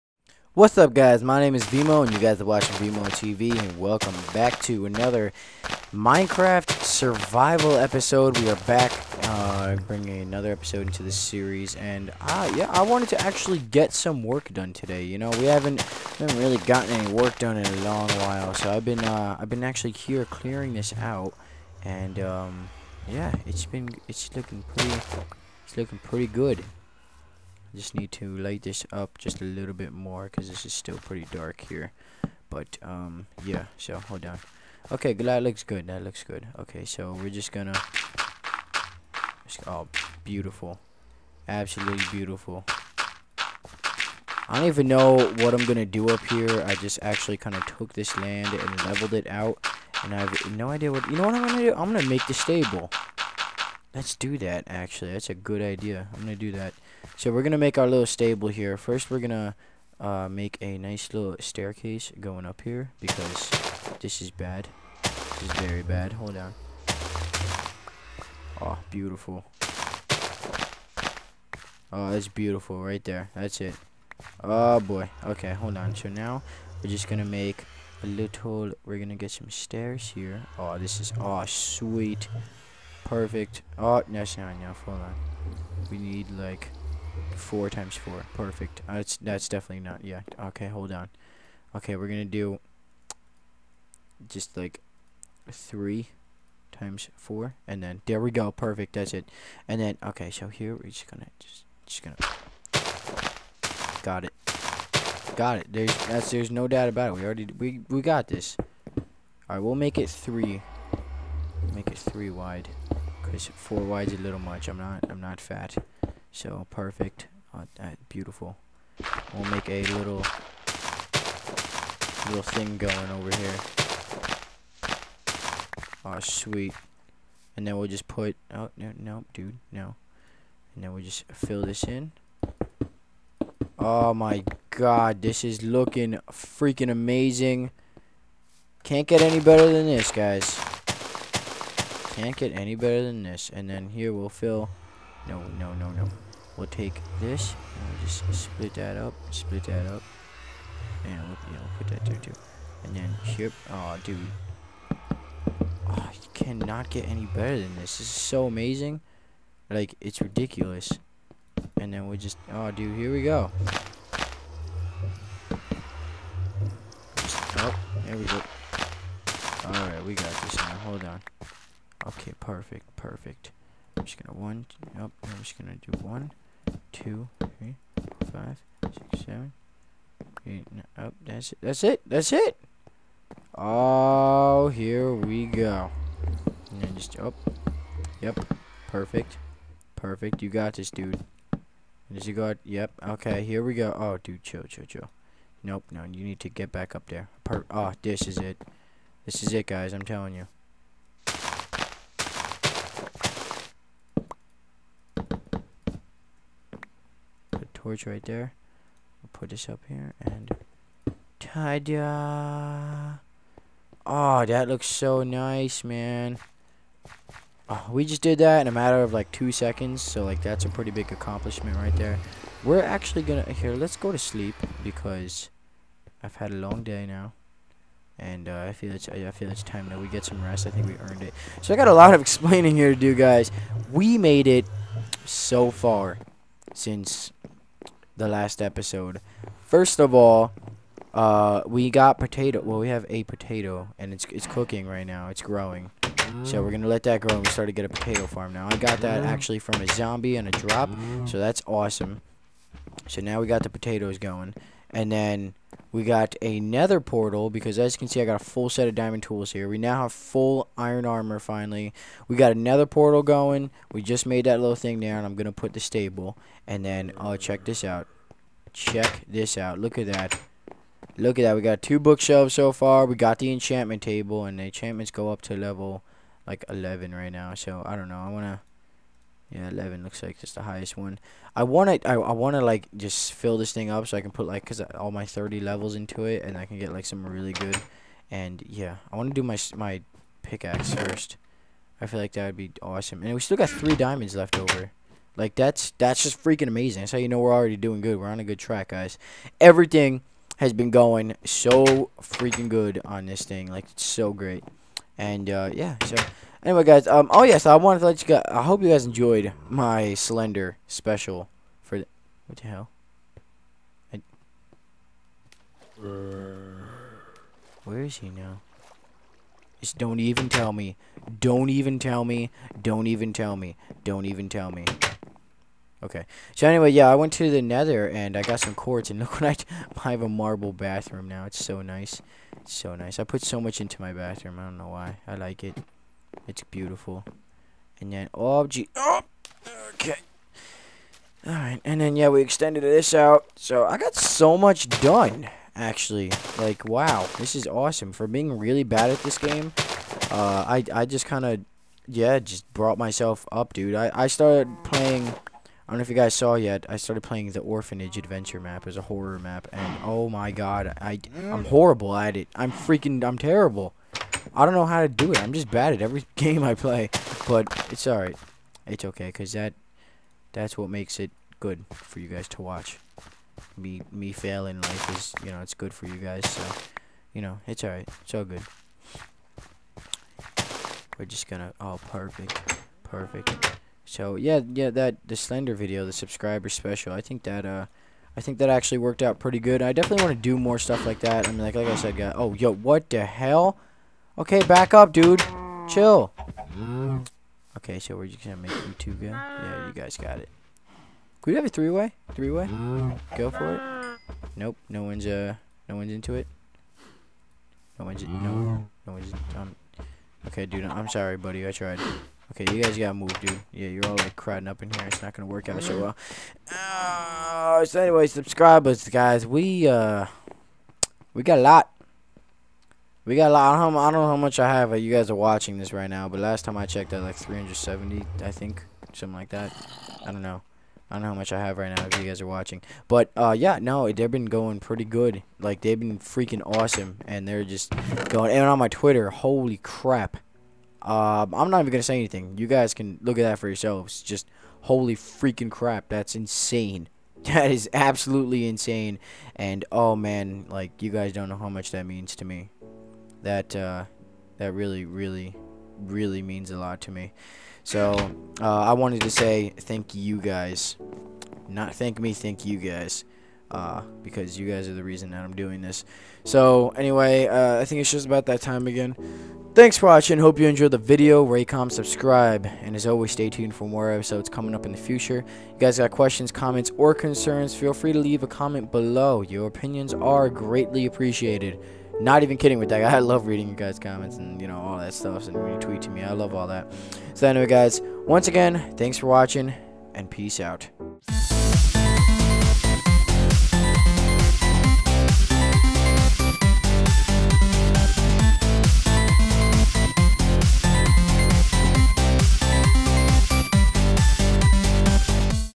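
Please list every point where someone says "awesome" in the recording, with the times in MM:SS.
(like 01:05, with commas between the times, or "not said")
04:11, 04:52, 05:47, 07:16.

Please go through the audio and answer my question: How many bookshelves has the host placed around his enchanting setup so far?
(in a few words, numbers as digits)
2.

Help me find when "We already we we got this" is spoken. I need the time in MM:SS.
01:47.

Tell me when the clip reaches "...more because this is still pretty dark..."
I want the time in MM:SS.
00:29.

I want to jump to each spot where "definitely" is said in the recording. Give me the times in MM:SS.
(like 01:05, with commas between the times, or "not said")
01:29, 06:29.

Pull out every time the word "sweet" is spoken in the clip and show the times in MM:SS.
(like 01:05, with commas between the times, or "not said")
01:21, 02:06.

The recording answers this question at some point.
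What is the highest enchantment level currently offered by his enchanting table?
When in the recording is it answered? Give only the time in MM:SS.
04:35.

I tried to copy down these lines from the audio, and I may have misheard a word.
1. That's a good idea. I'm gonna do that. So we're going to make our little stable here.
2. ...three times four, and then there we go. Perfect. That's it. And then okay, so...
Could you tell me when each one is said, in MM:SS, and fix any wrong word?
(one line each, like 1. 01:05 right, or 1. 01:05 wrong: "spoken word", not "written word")
1. 00:55 right
2. 01:35 right.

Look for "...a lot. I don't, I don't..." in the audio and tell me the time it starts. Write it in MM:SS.
07:03.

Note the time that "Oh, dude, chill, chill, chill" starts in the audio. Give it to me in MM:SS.
03:13.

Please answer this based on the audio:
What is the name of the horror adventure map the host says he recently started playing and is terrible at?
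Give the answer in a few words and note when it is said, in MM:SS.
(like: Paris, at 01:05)
Orphanage Adventure, at 05:57.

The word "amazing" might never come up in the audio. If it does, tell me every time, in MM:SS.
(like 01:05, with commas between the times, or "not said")
02:16, 02:38, 04:56.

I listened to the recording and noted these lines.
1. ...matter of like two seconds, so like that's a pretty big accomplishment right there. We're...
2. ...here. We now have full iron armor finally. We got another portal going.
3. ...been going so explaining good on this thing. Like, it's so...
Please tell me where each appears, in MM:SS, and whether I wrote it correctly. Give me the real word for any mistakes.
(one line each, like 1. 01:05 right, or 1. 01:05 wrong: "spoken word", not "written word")
1. 03:38 right
2. 04:19 right
3. 05:00 wrong: "freaking", not "explaining".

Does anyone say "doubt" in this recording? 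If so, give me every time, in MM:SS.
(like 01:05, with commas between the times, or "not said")
01:46.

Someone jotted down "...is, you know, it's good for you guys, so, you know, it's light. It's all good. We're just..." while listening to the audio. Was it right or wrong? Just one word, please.
wrong.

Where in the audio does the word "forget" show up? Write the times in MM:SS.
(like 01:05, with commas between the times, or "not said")
not said.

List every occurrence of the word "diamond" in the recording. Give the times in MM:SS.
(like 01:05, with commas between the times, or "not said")
04:18, 04:53.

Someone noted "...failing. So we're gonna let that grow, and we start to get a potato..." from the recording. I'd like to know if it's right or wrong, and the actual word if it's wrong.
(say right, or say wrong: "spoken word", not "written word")
wrong: "growing", not "failing".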